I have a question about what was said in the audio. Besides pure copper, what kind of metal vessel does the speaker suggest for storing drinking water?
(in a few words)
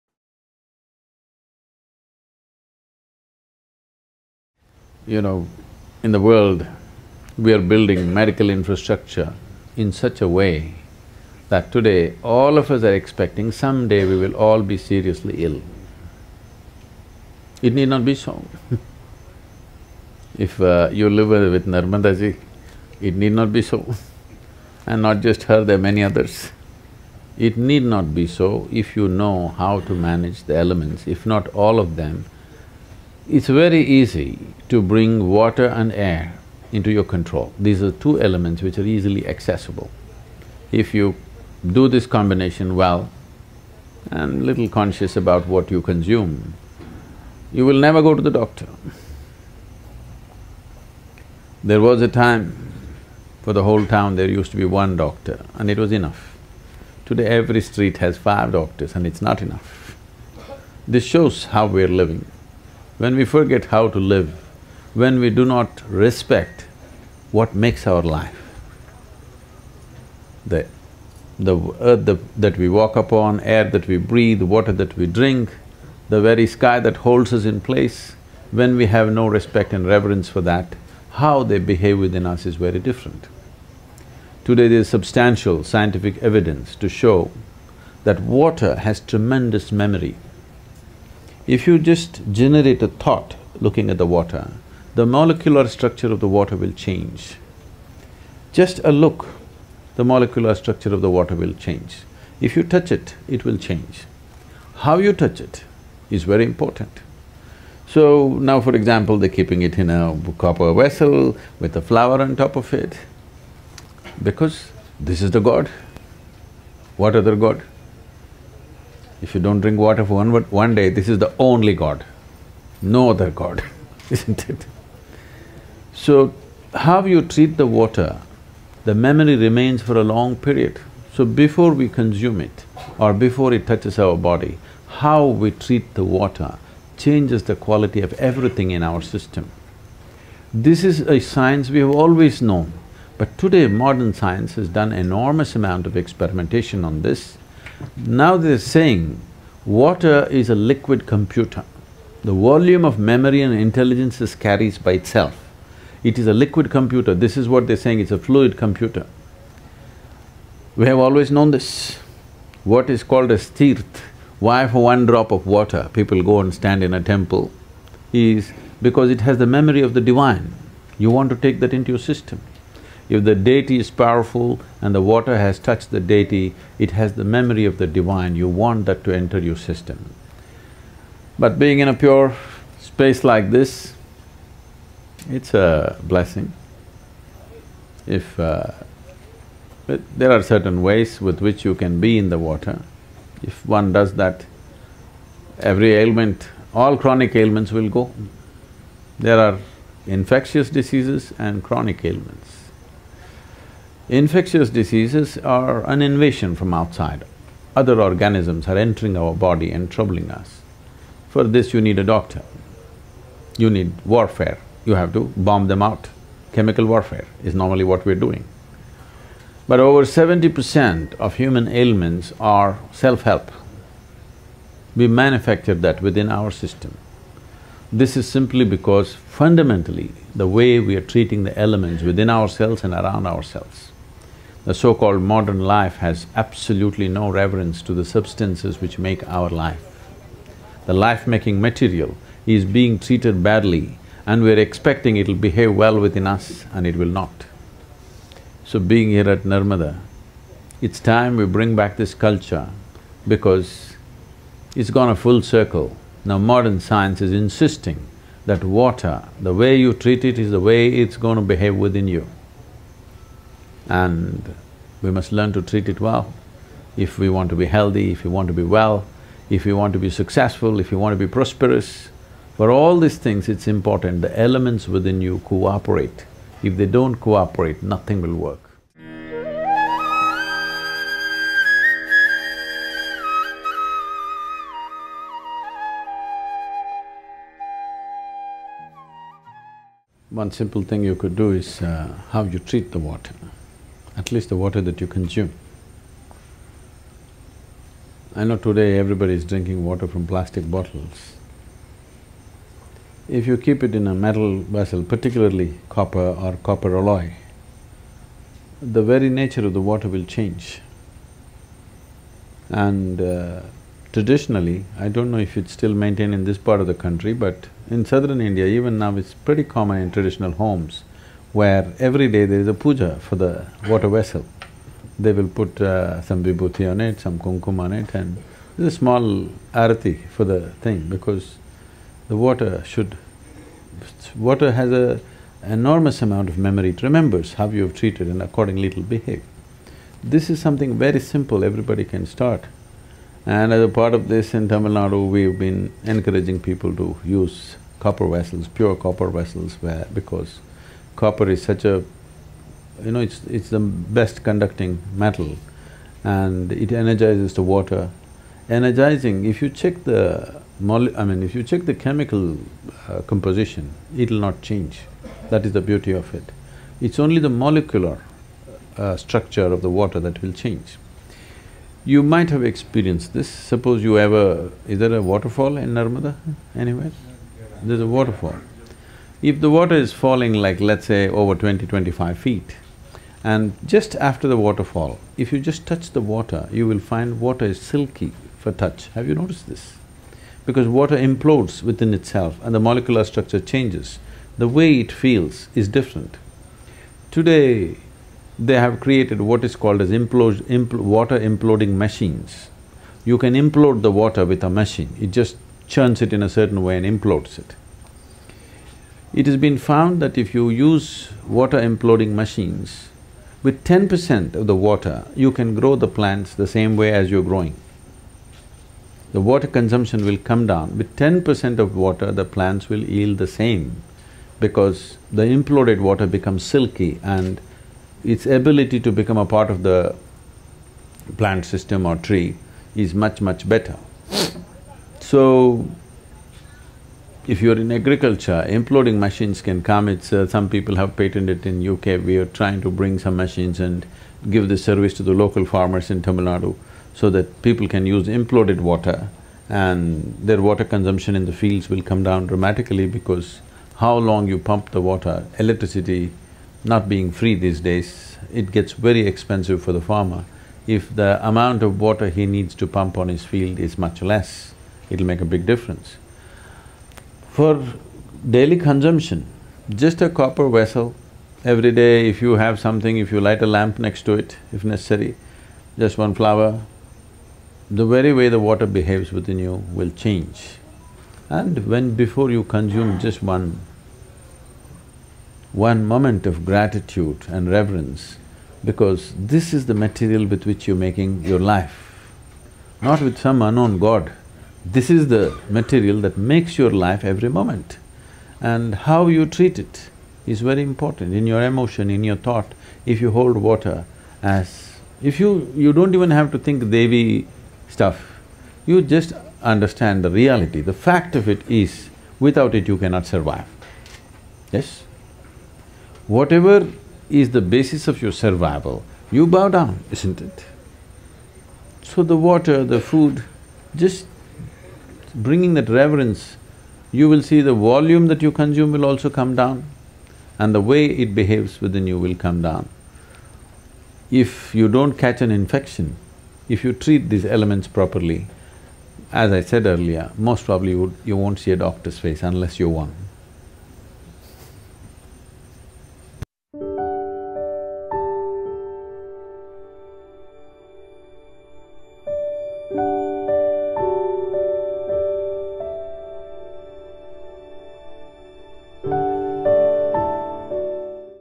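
copper alloy.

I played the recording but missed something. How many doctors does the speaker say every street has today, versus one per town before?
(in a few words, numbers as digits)
5.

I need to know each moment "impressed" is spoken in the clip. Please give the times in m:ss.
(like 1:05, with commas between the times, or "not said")
not said.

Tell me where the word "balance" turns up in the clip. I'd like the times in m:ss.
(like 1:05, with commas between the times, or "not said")
not said.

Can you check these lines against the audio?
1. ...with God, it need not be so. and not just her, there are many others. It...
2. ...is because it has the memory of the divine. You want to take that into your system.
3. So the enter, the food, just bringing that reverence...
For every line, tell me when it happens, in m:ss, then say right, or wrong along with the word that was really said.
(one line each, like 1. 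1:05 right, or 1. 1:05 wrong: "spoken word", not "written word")
1. 0:21 wrong: "Narmadaji", not "God"
2. 2:48 right
3. 8:42 wrong: "water", not "enter".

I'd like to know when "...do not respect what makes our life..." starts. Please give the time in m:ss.
1:05.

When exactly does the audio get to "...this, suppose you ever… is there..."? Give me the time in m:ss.
6:13.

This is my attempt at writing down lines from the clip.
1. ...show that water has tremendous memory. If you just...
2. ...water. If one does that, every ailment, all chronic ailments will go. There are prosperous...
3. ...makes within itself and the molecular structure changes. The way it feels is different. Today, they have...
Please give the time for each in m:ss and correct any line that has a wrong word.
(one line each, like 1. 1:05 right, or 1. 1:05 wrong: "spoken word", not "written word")
1. 1:26 right
2. 3:12 wrong: "infectious", not "prosperous"
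3. 6:31 wrong: "implodes", not "makes".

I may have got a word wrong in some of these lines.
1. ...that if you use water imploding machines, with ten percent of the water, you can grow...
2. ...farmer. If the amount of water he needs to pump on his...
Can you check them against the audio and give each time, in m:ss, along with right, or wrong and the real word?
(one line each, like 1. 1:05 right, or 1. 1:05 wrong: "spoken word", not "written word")
1. 6:50 right
2. 7:40 right.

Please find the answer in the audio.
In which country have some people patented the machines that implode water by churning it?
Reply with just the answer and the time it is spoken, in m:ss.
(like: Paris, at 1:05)
UK, at 7:21.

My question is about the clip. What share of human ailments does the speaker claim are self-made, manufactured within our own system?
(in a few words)
over 70 percent.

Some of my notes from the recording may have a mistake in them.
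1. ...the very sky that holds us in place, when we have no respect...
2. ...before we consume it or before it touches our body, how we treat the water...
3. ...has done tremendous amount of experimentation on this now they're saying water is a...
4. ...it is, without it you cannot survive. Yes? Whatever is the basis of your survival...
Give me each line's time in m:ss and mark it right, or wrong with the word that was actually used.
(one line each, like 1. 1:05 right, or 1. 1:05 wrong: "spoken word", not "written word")
1. 1:16 right
2. 2:11 right
3. 2:24 wrong: "enormous", not "tremendous"
4. 8:31 right.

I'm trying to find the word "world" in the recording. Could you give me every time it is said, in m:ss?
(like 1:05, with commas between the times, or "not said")
0:06.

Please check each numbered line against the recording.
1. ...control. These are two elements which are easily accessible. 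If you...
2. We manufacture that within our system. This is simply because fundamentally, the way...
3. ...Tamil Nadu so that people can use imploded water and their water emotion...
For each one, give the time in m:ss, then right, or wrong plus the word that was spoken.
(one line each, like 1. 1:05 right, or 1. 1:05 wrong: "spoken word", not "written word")
1. 0:37 right
2. 3:44 right
3. 7:26 wrong: "consumption", not "emotion".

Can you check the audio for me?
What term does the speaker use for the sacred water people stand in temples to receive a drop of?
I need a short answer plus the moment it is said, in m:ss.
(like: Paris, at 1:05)
tirth, at 2:43.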